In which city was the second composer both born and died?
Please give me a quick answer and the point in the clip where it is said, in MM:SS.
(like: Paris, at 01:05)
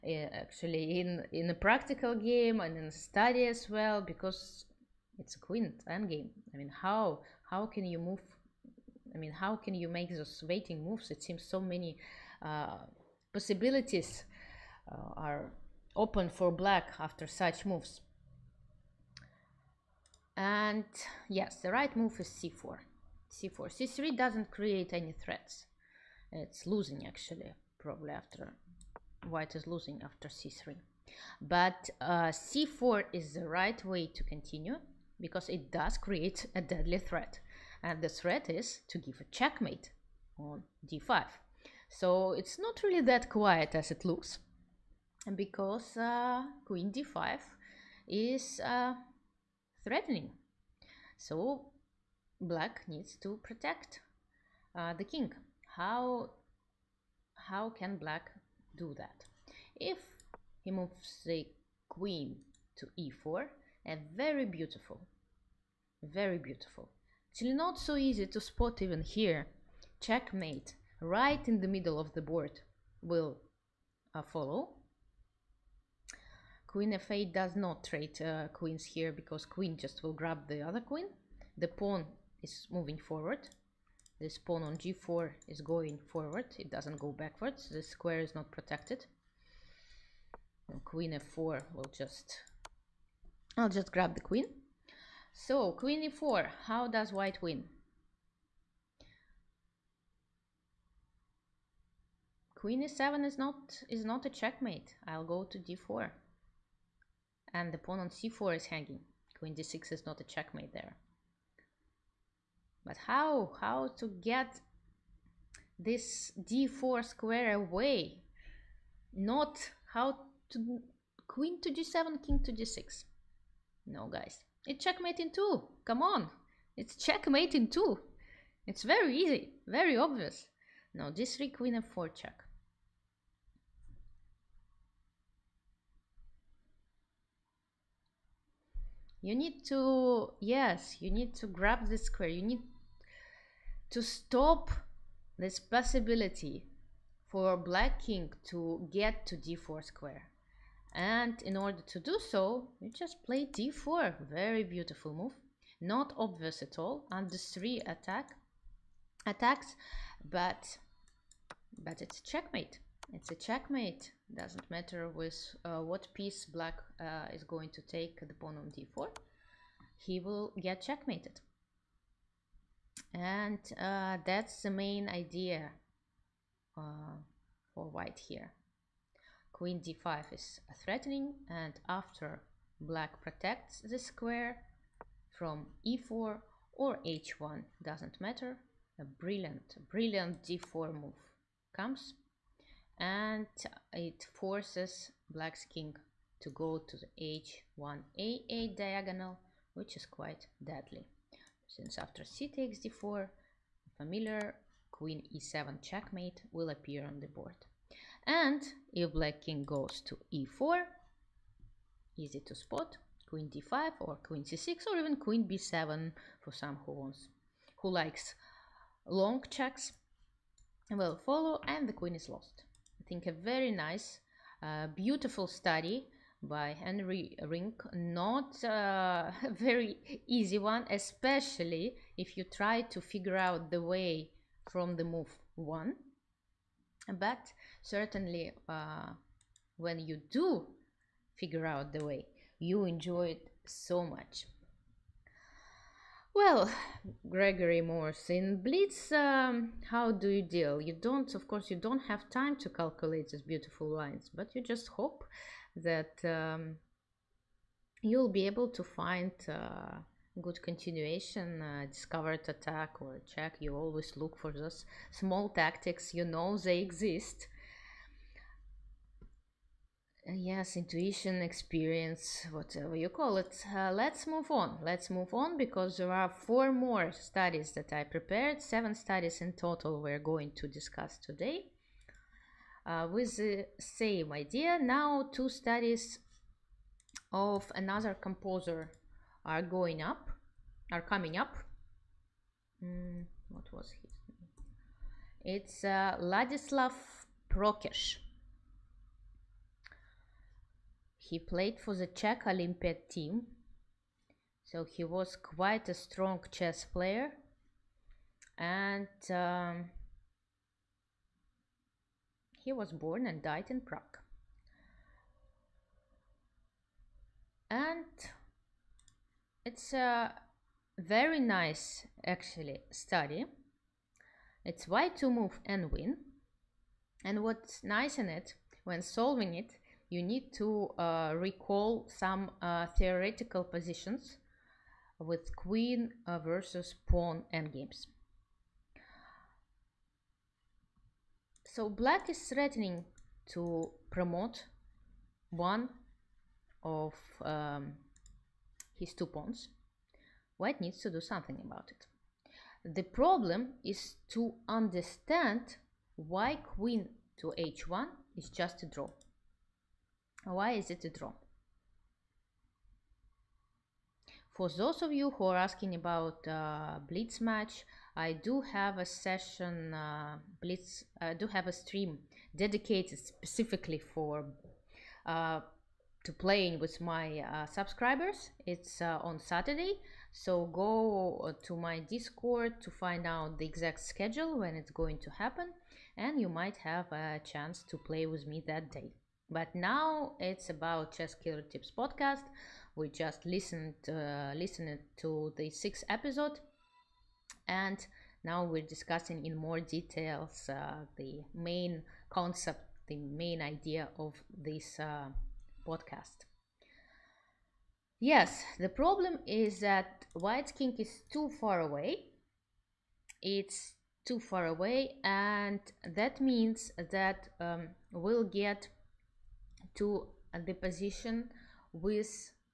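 Prague, at 05:13.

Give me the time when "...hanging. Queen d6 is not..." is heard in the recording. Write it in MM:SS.
01:48.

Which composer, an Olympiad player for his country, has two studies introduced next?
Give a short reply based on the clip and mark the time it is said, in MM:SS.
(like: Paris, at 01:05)
Ladislav Prokeš, at 04:56.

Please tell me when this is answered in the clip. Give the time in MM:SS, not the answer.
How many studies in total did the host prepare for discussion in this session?
04:38.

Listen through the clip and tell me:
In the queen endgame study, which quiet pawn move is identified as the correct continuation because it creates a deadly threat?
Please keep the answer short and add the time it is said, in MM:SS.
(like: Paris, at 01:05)
c4, at 00:21.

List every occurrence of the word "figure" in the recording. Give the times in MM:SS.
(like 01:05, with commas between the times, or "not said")
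03:53, 04:01.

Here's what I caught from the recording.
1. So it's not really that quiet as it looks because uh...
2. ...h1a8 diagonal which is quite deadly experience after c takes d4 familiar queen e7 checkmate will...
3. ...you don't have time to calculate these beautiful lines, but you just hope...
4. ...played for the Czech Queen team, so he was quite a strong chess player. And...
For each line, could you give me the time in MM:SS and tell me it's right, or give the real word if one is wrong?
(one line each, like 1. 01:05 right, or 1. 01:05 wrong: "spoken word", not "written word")
1. 00:41 right
2. 03:17 wrong: "since", not "experience"
3. 04:11 right
4. 05:01 wrong: "Olympiad", not "Queen".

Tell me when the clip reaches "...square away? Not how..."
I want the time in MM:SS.
01:57.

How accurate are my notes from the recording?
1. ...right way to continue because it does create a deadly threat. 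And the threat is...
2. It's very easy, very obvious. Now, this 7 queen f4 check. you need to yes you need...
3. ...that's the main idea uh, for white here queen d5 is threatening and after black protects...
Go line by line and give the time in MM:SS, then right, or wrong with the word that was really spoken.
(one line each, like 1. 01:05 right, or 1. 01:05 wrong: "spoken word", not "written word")
1. 00:33 right
2. 02:08 wrong: "3", not "7"
3. 02:54 right.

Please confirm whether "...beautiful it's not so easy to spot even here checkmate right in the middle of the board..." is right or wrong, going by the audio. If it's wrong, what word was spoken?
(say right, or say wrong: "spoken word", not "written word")
right.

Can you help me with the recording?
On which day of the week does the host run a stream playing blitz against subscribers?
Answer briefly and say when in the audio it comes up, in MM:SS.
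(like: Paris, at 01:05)
Saturday, at 06:19.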